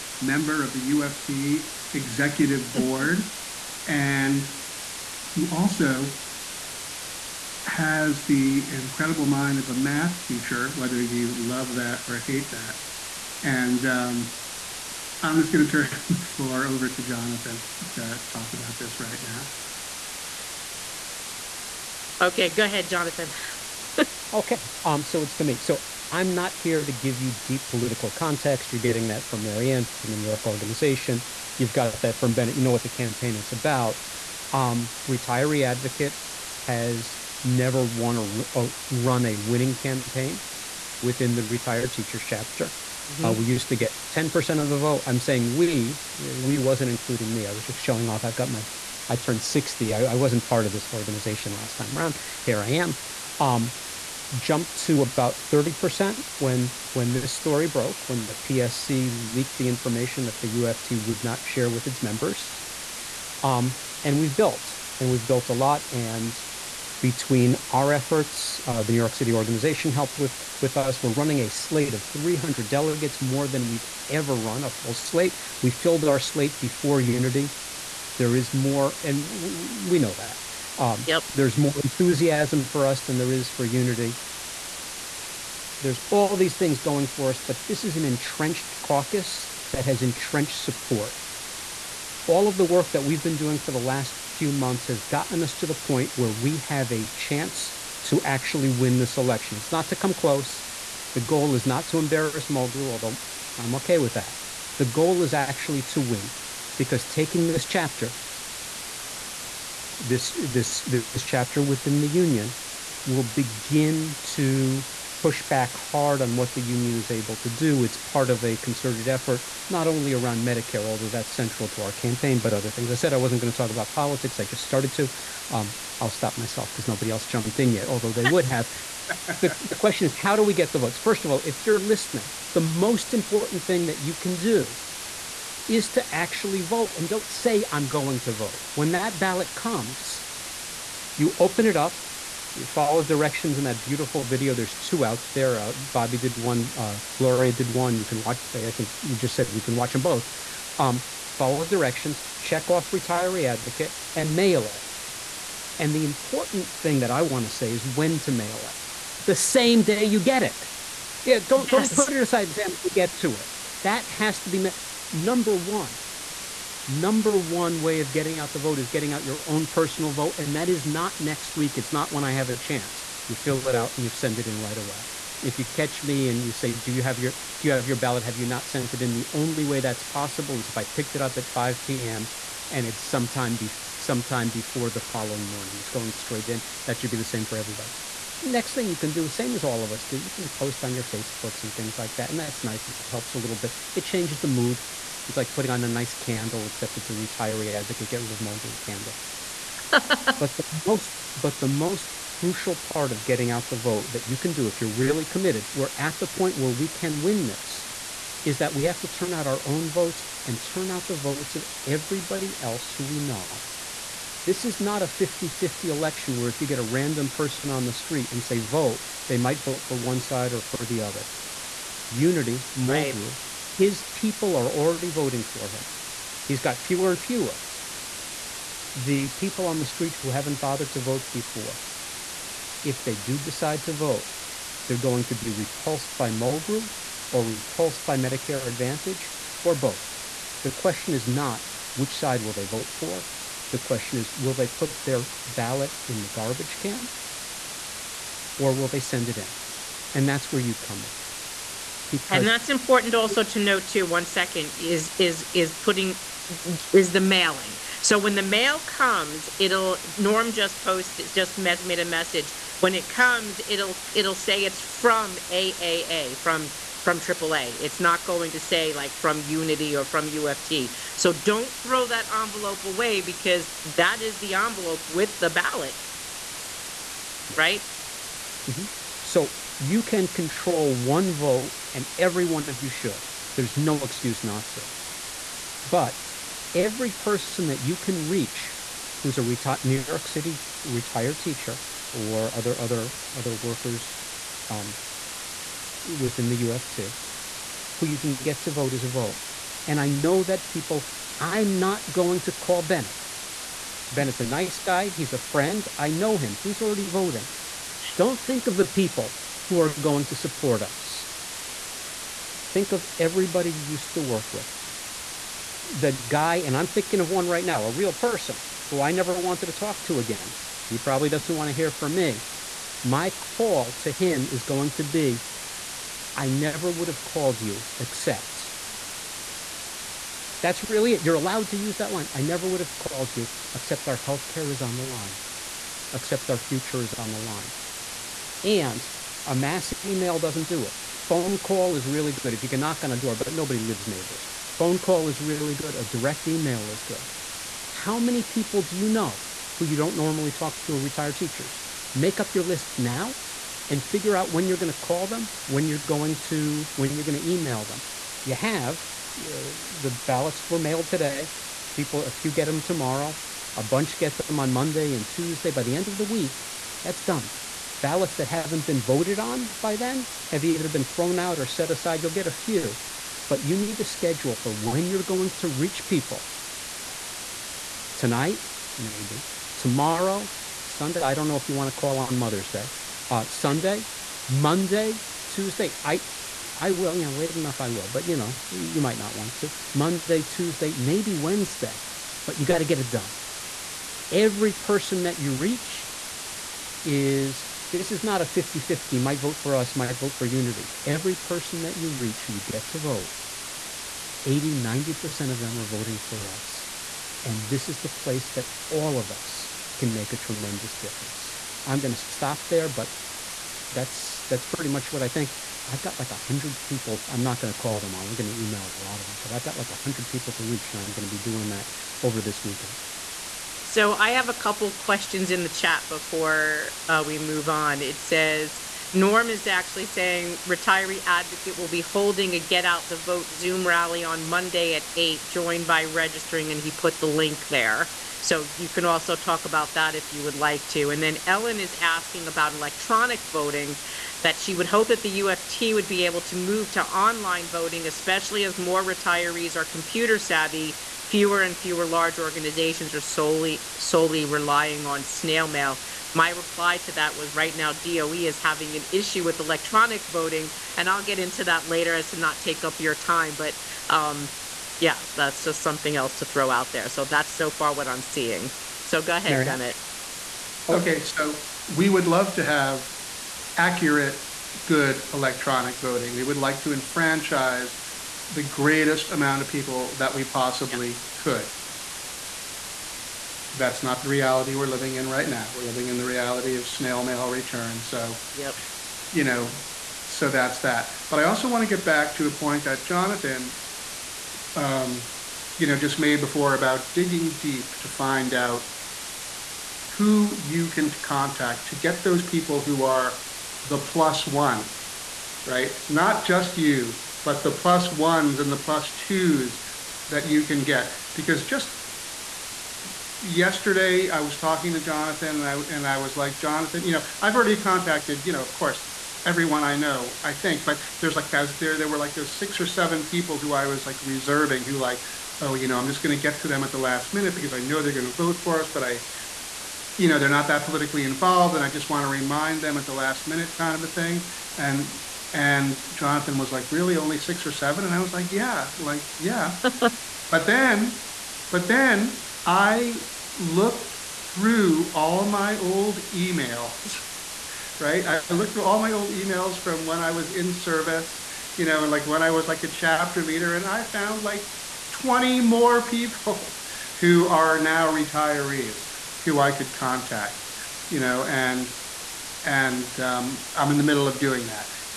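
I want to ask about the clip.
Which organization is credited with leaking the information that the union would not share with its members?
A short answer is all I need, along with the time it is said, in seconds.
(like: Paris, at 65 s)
PSC, at 58 s.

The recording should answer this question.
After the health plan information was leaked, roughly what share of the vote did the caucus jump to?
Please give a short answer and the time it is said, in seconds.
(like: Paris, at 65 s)
30%, at 55 s.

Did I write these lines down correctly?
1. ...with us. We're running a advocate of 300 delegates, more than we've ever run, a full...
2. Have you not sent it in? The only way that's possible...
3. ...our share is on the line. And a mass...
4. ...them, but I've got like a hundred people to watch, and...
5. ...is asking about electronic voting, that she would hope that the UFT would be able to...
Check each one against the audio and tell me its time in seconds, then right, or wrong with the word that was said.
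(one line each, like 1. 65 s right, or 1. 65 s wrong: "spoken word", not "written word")
1. 70 s wrong: "slate", not "advocate"
2. 178 s right
3. 336 s wrong: "future", not "share"
4. 419 s wrong: "reach", not "watch"
5. 441 s right.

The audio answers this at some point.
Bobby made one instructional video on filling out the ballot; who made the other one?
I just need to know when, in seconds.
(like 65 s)
147 s.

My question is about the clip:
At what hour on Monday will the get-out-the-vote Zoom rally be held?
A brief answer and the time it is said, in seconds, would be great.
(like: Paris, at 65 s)
8, at 435 s.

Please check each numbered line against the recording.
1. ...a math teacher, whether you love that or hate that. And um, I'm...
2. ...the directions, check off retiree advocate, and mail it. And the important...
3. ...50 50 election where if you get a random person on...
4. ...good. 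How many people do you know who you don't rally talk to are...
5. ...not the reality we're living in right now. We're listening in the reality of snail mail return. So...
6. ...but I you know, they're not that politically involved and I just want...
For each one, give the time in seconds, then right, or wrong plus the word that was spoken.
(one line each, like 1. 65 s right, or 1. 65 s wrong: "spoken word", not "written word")
1. 9 s right
2. 151 s right
3. 215 s right
4. 347 s wrong: "normally", not "rally"
5. 484 s wrong: "living", not "listening"
6. 528 s right.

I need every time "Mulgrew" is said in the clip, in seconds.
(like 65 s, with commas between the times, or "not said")
102 s, 198 s, 222 s, 236 s.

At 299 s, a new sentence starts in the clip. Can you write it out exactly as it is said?
And I know that people, I'm not going to call Bennett.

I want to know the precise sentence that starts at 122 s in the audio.
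I said I wasn't going to talk about politics.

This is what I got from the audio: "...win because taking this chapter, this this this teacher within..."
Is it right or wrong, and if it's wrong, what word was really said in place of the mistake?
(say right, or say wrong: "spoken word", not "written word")
wrong: "chapter", not "teacher".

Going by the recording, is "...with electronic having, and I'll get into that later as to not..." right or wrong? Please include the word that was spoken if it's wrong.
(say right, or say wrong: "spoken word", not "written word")
wrong: "voting", not "having".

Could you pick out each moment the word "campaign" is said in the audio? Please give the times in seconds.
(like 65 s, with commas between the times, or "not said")
32 s, 39 s, 121 s.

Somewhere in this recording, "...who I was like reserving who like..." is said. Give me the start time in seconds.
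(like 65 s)
523 s.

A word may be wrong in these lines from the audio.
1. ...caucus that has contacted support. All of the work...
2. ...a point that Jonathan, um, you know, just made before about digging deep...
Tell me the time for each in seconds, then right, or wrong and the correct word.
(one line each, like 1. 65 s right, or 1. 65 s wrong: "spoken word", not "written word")
1. 88 s wrong: "entrenched", not "contacted"
2. 492 s right.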